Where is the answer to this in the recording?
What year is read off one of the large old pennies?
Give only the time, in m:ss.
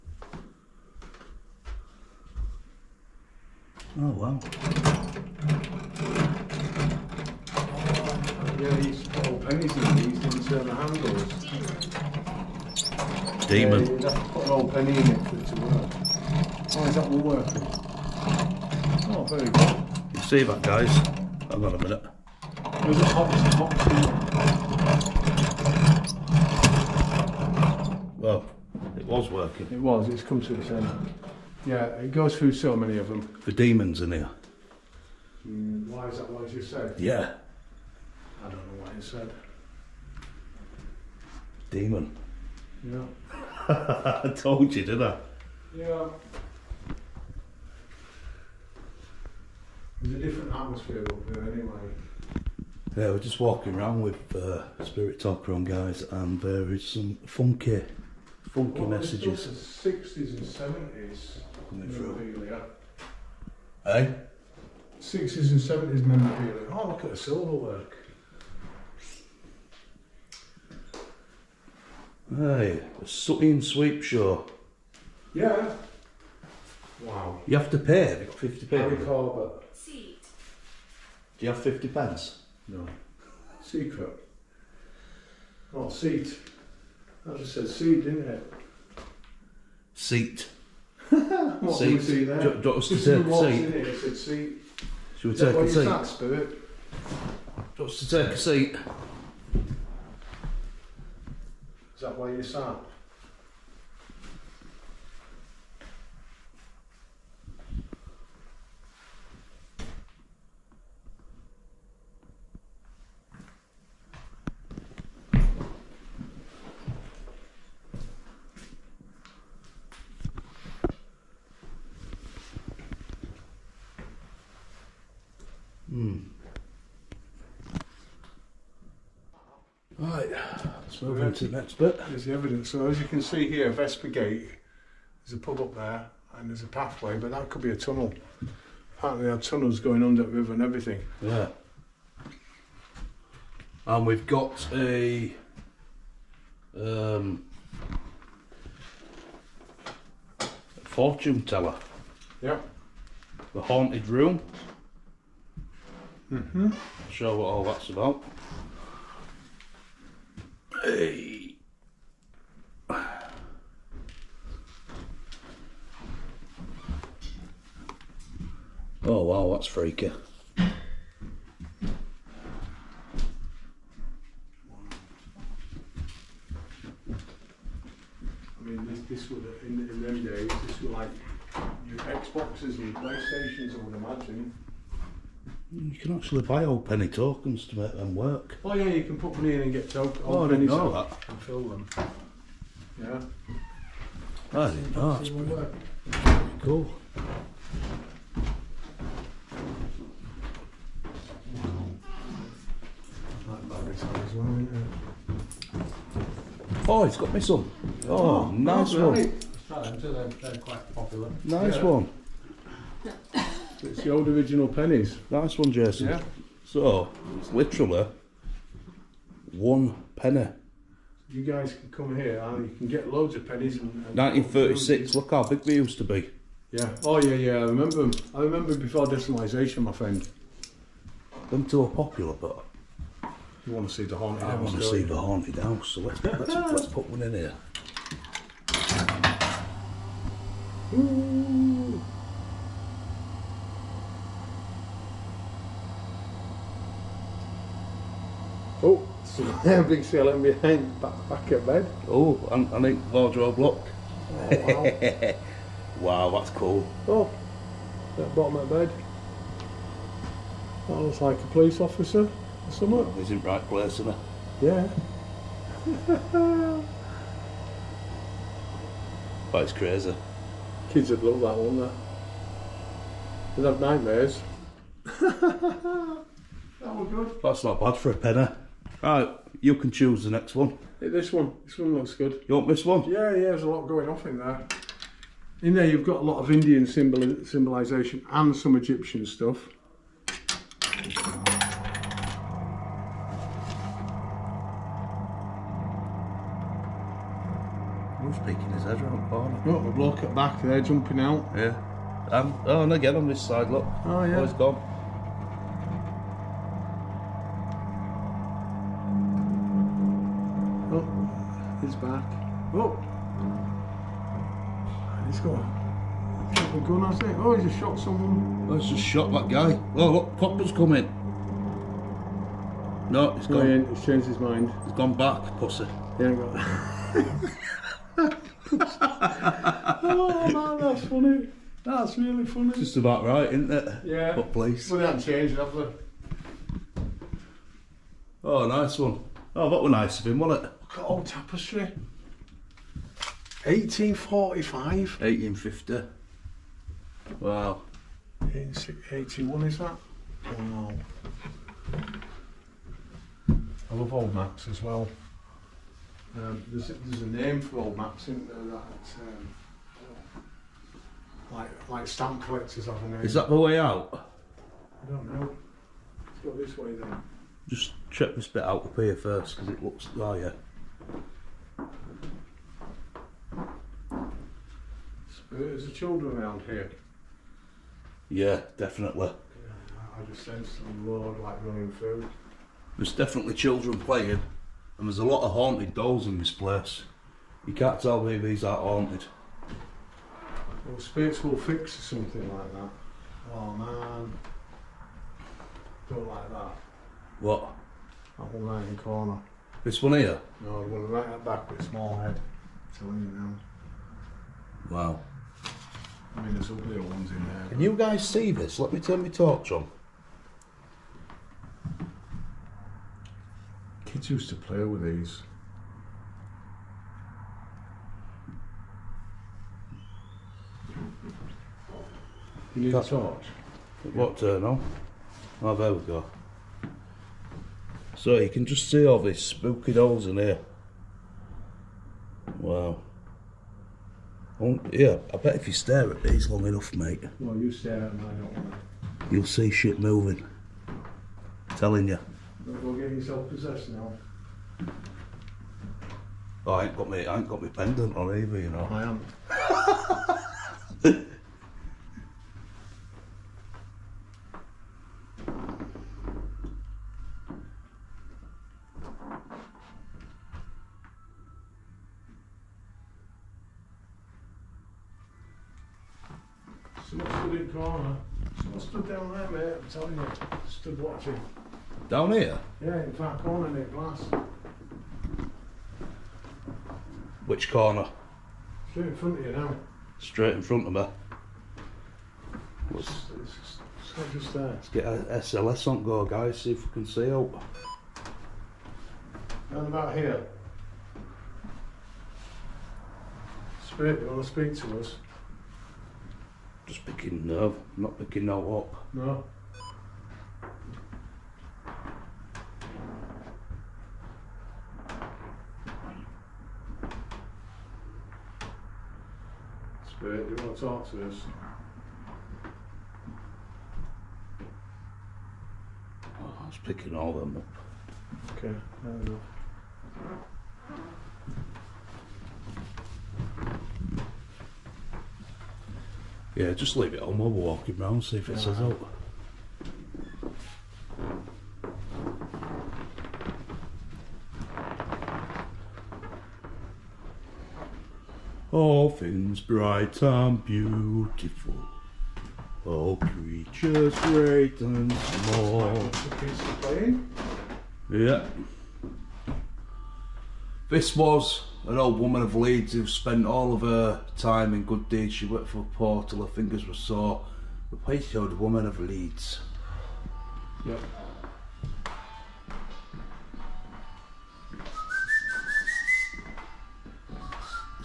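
3:44.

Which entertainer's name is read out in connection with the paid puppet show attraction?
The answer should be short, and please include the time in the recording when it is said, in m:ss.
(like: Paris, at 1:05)
Harry Corbett, at 1:18.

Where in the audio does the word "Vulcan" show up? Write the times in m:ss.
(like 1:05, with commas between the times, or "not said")
not said.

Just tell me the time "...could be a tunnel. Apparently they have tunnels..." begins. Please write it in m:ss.
2:17.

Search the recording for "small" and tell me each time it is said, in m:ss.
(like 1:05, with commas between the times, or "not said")
6:41, 9:05.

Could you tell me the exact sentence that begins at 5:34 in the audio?
Well, they haven't changed, have they?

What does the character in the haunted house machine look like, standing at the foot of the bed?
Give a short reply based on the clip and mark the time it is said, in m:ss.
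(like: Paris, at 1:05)
a police officer, at 4:21.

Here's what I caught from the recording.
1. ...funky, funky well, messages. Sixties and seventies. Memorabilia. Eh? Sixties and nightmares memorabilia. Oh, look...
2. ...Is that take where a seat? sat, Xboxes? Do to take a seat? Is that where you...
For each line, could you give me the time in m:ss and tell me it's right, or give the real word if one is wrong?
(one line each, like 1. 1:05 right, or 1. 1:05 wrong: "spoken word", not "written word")
1. 0:57 wrong: "seventies", not "nightmares"
2. 1:35 wrong: "Spirit", not "Xboxes".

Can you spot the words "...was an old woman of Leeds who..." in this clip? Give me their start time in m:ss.
9:11.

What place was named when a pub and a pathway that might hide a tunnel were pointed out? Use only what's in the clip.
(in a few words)
Vesper Gate.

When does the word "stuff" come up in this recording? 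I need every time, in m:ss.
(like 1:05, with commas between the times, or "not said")
4:49.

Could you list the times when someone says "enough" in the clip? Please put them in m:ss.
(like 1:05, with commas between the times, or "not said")
7:16, 8:39.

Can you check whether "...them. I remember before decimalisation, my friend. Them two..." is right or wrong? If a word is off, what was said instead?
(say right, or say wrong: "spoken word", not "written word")
right.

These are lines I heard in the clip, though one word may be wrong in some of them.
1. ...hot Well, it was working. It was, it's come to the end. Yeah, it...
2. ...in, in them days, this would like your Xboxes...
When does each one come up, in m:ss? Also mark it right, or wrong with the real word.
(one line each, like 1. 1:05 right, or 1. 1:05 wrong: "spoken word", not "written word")
1. 0:24 right
2. 2:59 right.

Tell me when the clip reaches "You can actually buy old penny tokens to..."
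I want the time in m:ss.
3:05.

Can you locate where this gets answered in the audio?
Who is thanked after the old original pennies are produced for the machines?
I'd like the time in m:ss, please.
3:35.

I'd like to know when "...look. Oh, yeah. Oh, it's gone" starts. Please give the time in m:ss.
5:03.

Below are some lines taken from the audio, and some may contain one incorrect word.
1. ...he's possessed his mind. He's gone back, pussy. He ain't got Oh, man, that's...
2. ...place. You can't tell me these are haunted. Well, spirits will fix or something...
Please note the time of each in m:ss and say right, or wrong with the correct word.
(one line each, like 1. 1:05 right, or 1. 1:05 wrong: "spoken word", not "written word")
1. 5:23 wrong: "changed", not "possessed"
2. 6:26 right.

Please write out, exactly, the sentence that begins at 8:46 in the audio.
Yeah, just leave it on while we're walking round, see if it says out.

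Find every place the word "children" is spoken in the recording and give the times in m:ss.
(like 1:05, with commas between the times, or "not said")
6:15, 6:23.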